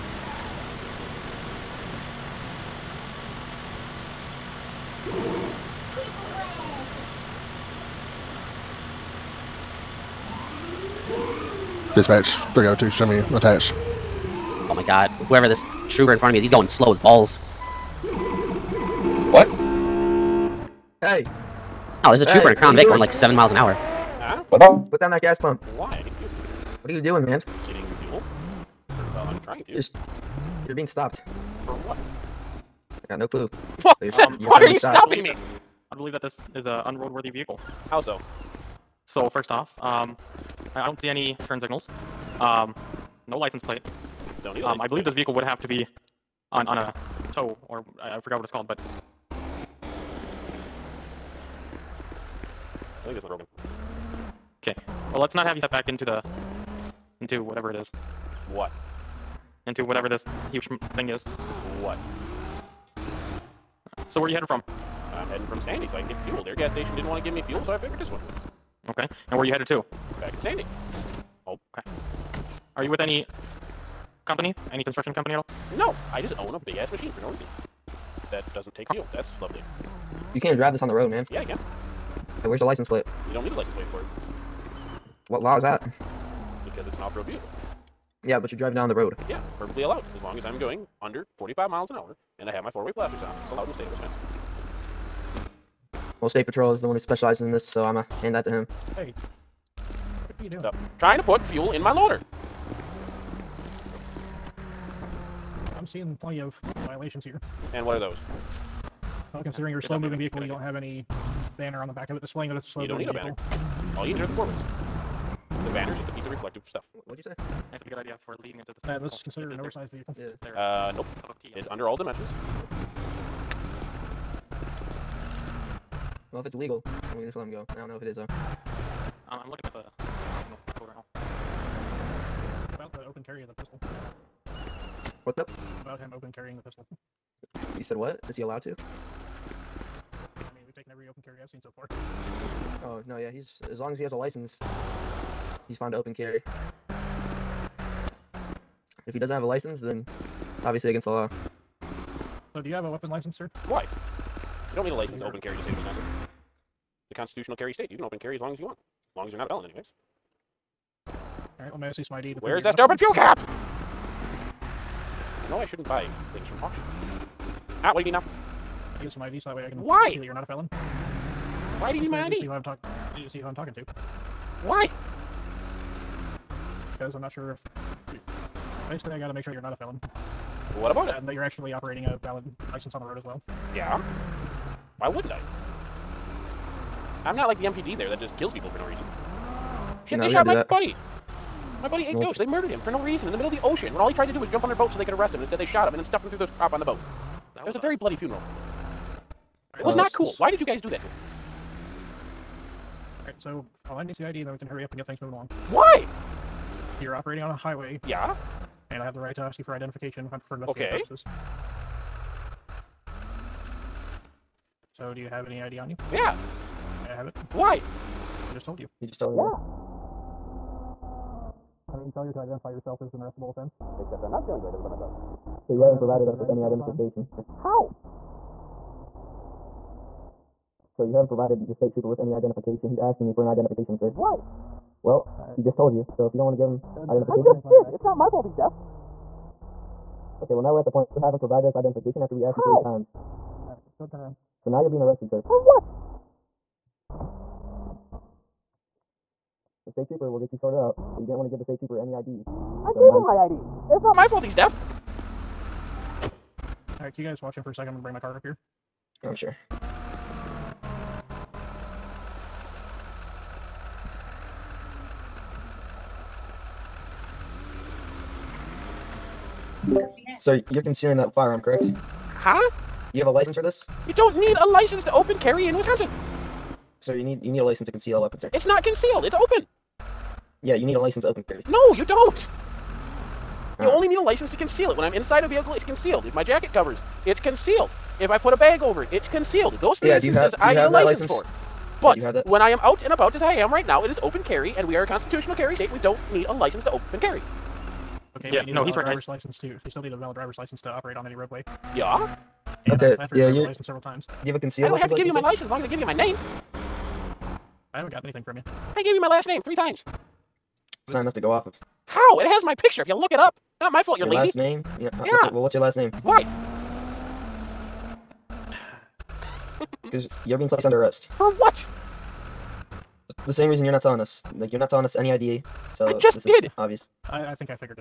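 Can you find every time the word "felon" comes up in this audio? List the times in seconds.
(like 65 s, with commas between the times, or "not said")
159 s, 170 s, 179 s.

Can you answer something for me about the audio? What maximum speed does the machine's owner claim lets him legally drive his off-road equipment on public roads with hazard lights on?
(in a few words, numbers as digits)
45 miles an hour.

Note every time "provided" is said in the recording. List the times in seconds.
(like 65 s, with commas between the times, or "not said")
225 s, 231 s, 241 s.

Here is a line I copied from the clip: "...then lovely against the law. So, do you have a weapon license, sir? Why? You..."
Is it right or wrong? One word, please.
wrong.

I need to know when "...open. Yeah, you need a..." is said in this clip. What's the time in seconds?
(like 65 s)
279 s.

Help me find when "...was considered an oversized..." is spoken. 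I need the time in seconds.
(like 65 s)
119 s.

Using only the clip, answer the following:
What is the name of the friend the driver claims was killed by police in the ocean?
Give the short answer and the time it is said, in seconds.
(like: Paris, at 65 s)
Ghost, at 192 s.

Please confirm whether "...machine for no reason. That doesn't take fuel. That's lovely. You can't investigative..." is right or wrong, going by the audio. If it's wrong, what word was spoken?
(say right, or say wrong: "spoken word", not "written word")
wrong: "drive", not "investigative".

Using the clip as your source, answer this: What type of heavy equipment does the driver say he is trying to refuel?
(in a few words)
loader.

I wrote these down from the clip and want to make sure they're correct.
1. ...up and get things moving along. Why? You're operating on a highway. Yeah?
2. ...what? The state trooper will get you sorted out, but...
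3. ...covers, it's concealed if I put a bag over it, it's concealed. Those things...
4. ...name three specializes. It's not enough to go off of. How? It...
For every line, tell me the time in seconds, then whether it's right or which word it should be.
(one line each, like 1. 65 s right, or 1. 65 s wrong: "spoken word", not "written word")
1. 204 s right
2. 245 s right
3. 286 s right
4. 309 s wrong: "times", not "specializes".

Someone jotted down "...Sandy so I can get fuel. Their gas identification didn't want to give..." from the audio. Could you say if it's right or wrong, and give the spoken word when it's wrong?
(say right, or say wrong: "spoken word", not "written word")
wrong: "station", not "identification".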